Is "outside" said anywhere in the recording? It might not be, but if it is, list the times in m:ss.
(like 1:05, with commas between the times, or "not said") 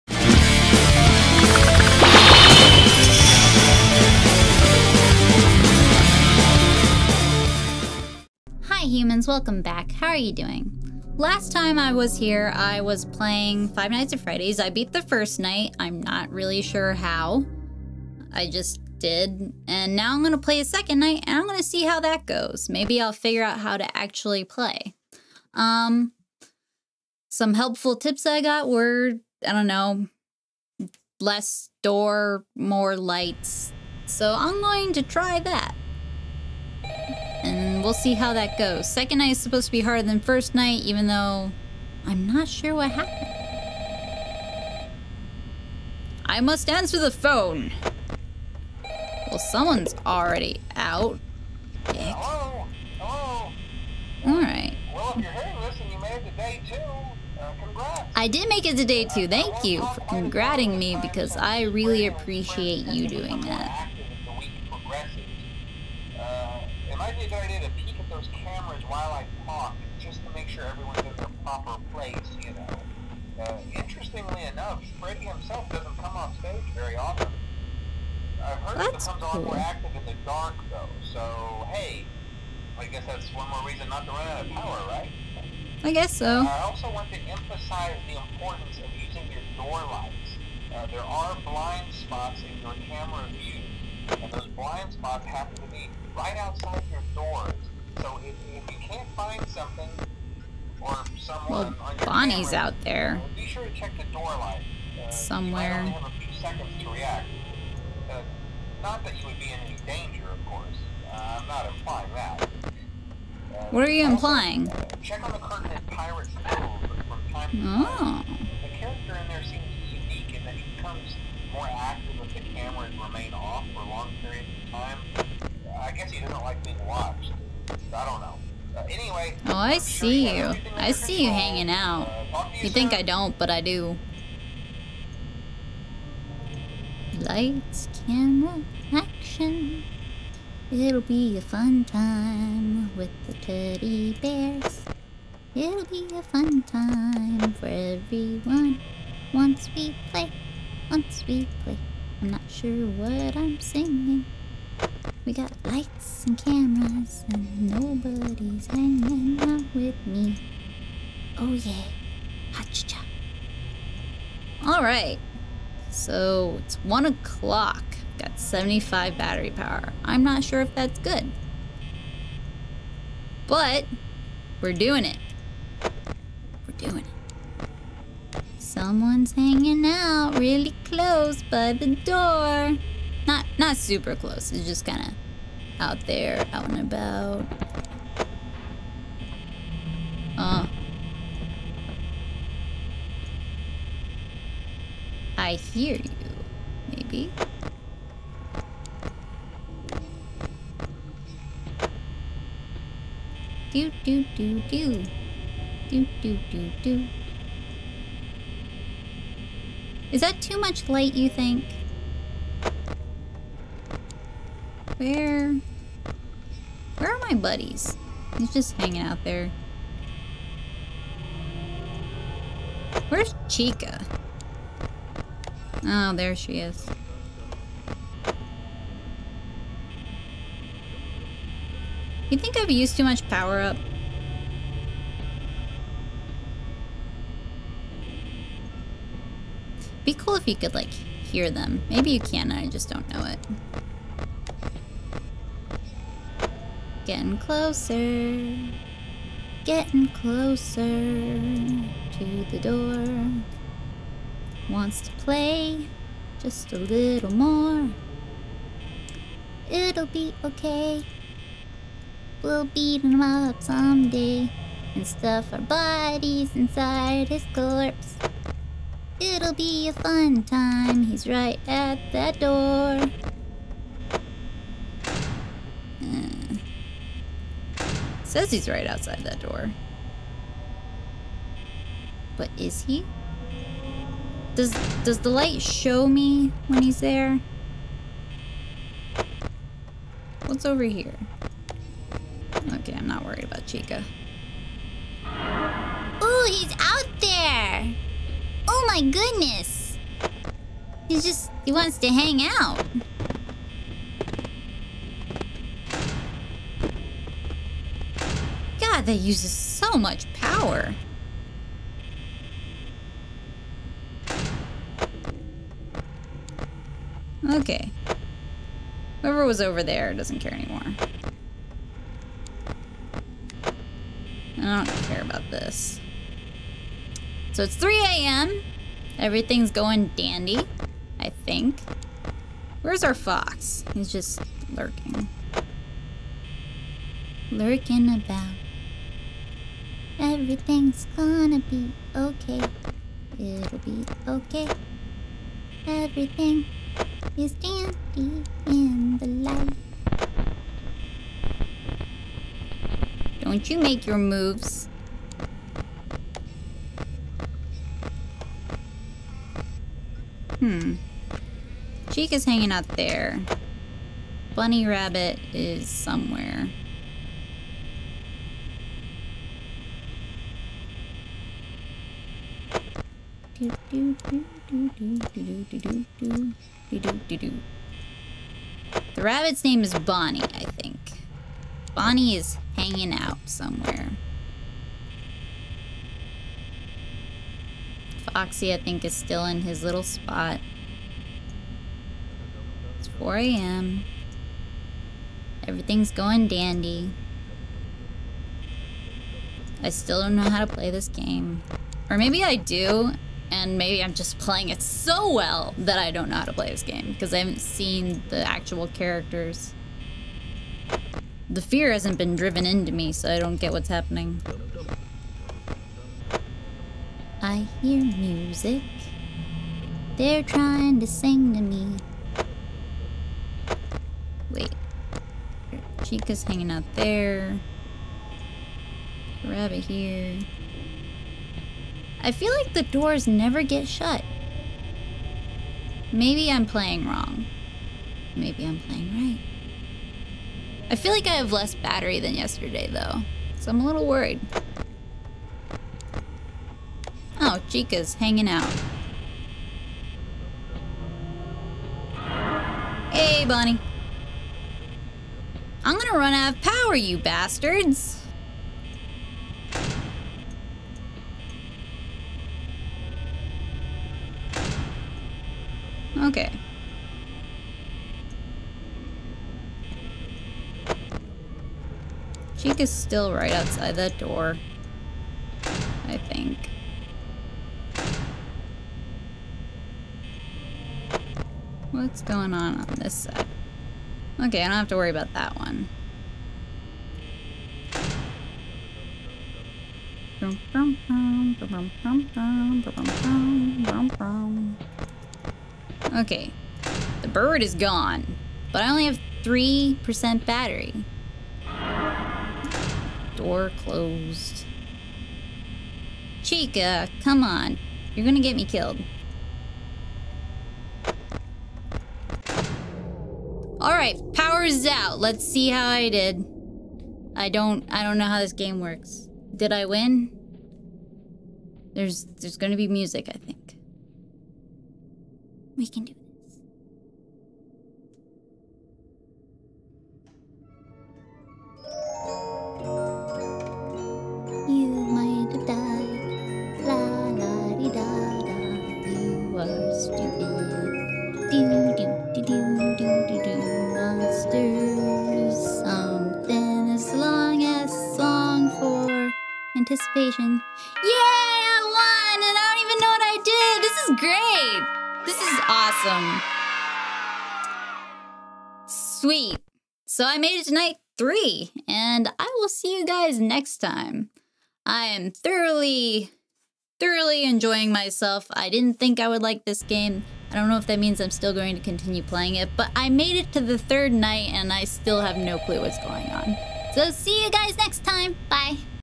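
1:36, 4:38, 7:53.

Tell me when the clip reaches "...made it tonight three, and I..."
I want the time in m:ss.
9:20.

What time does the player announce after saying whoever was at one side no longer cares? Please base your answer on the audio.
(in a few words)
3 a.m.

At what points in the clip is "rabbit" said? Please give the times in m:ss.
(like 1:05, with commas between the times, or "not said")
6:04, 6:19, 7:09.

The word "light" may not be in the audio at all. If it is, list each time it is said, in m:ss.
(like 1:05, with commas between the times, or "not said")
0:32, 1:29, 1:44, 2:17, 2:35, 3:30, 4:45, 5:49.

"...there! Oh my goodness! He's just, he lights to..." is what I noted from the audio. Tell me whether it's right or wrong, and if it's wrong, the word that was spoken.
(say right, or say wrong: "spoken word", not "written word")
wrong: "wants", not "lights".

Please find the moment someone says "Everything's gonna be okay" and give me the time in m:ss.
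5:40.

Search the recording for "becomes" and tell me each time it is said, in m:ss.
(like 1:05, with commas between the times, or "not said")
1:19, 2:00.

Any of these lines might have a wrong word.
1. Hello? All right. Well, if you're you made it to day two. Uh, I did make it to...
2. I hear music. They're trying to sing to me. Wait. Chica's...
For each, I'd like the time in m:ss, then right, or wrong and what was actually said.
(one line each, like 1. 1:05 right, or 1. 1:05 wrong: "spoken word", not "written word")
1. 0:52 right
2. 6:57 right.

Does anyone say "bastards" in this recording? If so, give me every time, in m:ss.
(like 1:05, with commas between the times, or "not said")
7:37.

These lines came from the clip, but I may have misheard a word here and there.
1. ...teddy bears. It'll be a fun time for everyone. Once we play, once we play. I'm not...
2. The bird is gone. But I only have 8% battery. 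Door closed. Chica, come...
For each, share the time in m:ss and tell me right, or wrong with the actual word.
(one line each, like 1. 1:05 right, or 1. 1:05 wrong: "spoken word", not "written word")
1. 2:23 right
2. 8:17 wrong: "3", not "8".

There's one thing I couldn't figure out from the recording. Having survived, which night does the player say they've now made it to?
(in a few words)
Third night.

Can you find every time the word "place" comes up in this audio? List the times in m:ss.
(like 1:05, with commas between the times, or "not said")
1:11.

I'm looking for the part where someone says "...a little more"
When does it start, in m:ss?
4:16.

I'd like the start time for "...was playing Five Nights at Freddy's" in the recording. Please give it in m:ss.
0:12.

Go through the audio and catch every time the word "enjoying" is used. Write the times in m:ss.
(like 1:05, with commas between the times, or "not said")
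9:27.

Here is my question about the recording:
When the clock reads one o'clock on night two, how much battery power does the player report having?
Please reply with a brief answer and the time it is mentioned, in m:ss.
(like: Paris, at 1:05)
75, at 2:48.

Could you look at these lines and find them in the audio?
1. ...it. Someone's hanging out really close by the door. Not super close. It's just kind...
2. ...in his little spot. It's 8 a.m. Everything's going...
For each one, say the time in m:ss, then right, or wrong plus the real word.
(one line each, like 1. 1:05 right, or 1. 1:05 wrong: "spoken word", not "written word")
1. 2:57 right
2. 6:29 wrong: "4", not "8".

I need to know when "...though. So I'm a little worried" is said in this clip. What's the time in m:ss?
7:22.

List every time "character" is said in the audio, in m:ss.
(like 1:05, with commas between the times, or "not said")
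1:58, 6:48.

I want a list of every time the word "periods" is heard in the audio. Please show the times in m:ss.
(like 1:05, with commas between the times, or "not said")
2:04.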